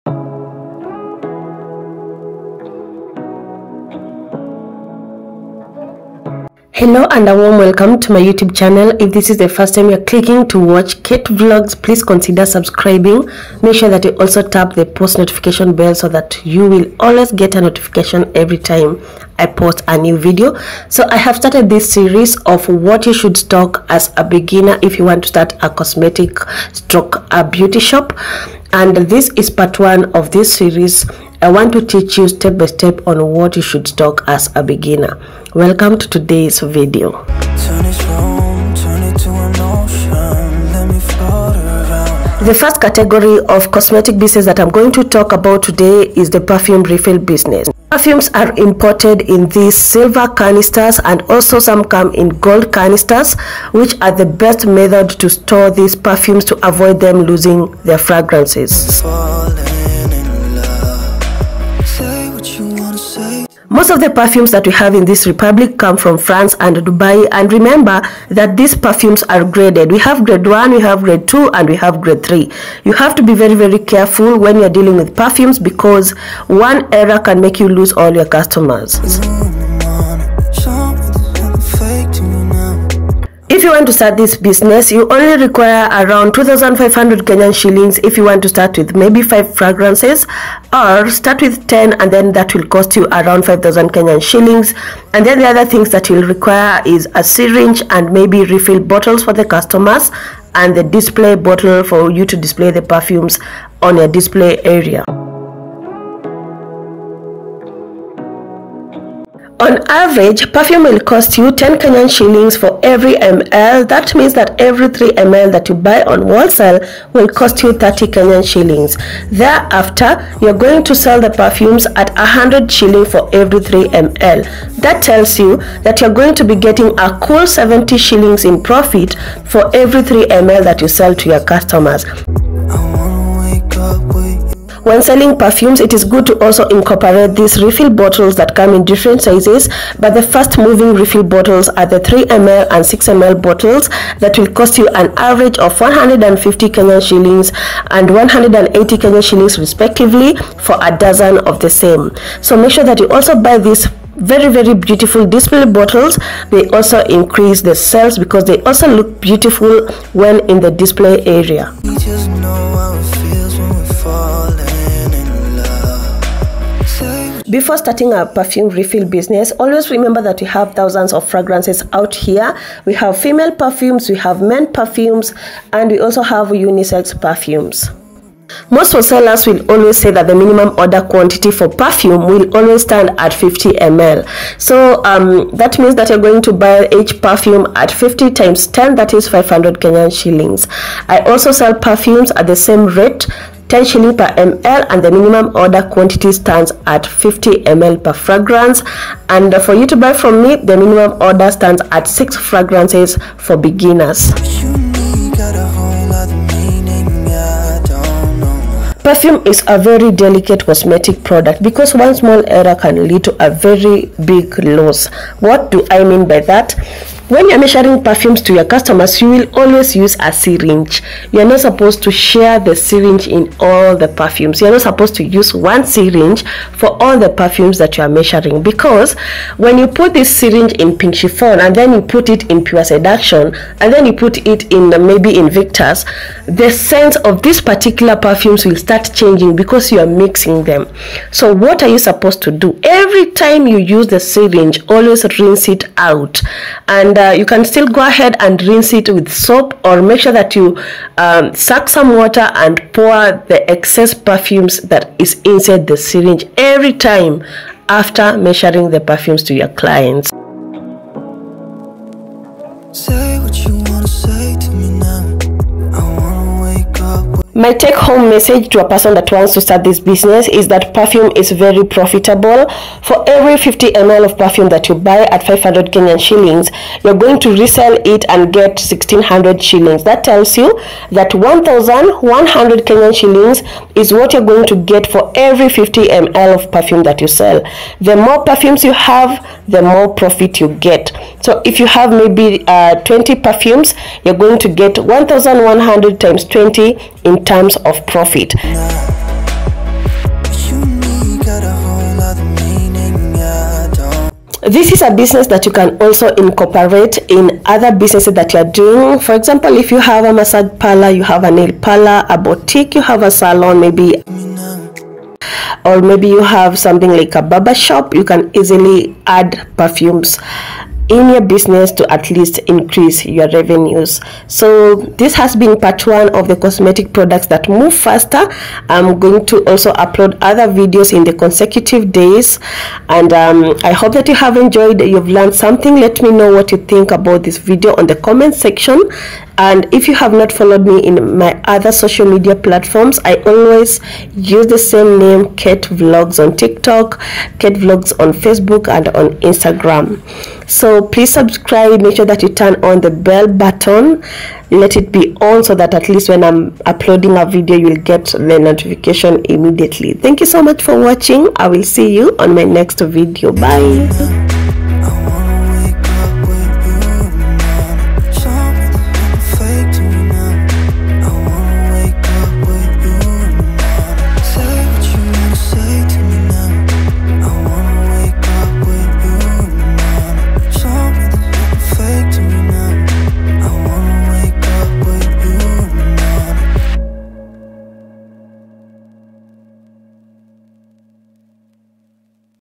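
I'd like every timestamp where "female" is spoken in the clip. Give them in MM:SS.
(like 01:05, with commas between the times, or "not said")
02:53.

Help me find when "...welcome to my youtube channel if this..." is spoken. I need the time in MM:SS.
00:07.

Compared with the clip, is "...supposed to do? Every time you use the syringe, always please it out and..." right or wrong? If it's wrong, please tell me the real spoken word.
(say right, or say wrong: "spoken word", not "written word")
wrong: "rinse", not "please".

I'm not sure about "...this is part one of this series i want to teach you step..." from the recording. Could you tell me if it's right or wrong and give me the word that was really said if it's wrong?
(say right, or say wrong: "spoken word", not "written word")
right.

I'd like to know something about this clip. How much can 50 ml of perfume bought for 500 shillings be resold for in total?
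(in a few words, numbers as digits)
1600 shillings.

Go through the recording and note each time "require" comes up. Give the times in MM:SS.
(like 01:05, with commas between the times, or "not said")
01:25, 01:36.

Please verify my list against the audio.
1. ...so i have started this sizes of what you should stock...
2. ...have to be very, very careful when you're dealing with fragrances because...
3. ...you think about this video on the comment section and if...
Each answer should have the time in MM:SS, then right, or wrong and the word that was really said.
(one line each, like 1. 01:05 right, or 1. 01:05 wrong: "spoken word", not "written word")
1. 00:20 wrong: "series", not "sizes"
2. 01:12 wrong: "perfumes", not "fragrances"
3. 05:36 right.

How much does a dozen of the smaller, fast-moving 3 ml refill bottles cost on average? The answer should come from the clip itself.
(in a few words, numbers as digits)
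150 Kenyan shillings.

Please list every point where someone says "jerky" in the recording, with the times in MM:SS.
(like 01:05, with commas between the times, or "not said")
not said.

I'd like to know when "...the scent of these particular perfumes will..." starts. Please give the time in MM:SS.
03:56.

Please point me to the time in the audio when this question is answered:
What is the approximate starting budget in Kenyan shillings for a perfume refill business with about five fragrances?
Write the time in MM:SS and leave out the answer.
01:26.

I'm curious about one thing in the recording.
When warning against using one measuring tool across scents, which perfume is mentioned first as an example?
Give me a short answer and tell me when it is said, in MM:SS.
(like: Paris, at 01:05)
Pink Chiffon, at 03:50.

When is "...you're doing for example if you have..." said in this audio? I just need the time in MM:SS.
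05:08.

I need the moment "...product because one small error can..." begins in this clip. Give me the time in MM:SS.
03:31.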